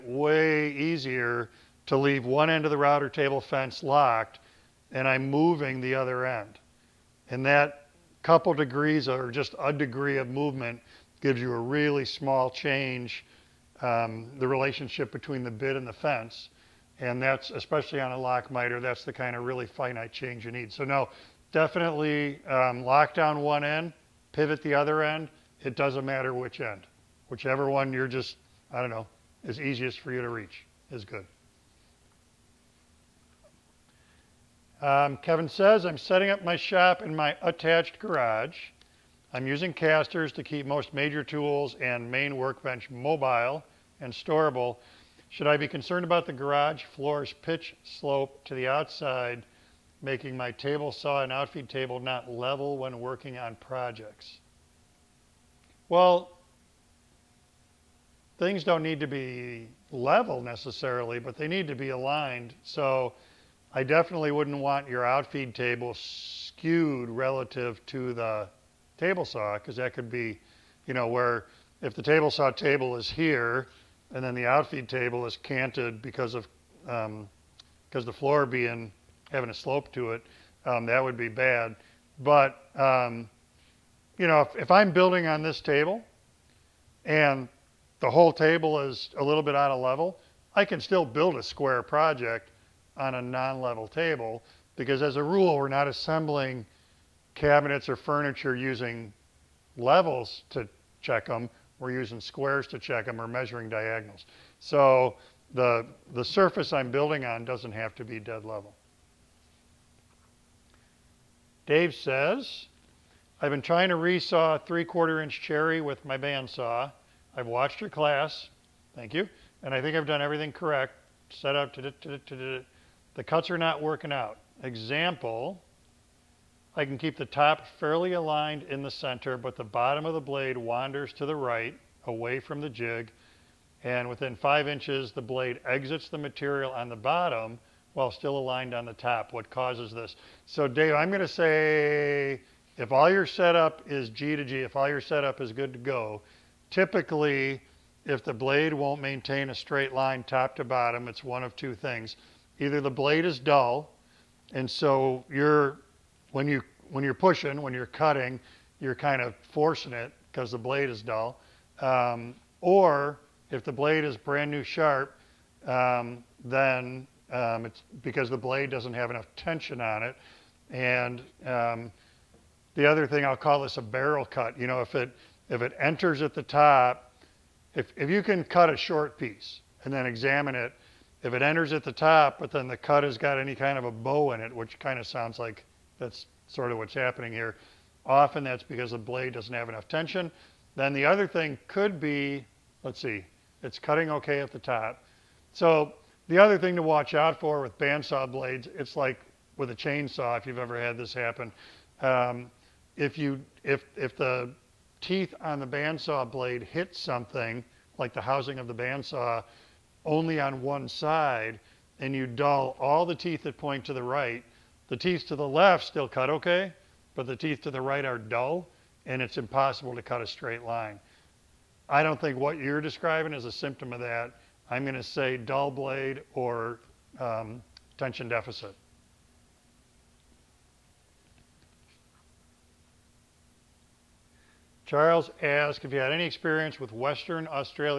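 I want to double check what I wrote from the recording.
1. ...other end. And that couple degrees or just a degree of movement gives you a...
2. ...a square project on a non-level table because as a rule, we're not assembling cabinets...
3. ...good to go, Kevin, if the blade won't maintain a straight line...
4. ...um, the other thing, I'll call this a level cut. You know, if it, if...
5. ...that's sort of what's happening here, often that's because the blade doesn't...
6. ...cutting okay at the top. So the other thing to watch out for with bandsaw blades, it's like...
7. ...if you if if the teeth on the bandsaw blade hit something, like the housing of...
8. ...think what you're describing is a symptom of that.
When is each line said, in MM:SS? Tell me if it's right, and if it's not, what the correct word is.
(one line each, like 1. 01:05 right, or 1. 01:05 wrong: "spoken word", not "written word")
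1. 00:05 right
2. 01:31 right
3. 02:25 wrong: "Typically", not "Kevin"
4. 02:51 wrong: "barrel", not "level"
5. 03:05 right
6. 03:13 right
7. 03:22 right
8. 03:42 right.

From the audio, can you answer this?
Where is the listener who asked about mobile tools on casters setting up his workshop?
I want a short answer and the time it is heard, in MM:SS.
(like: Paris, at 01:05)
Attached garage, at 00:37.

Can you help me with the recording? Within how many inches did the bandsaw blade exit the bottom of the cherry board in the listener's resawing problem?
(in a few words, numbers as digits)
5 inches.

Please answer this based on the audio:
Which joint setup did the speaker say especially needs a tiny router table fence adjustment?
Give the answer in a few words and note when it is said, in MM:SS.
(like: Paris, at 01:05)
Lock miter, at 00:18.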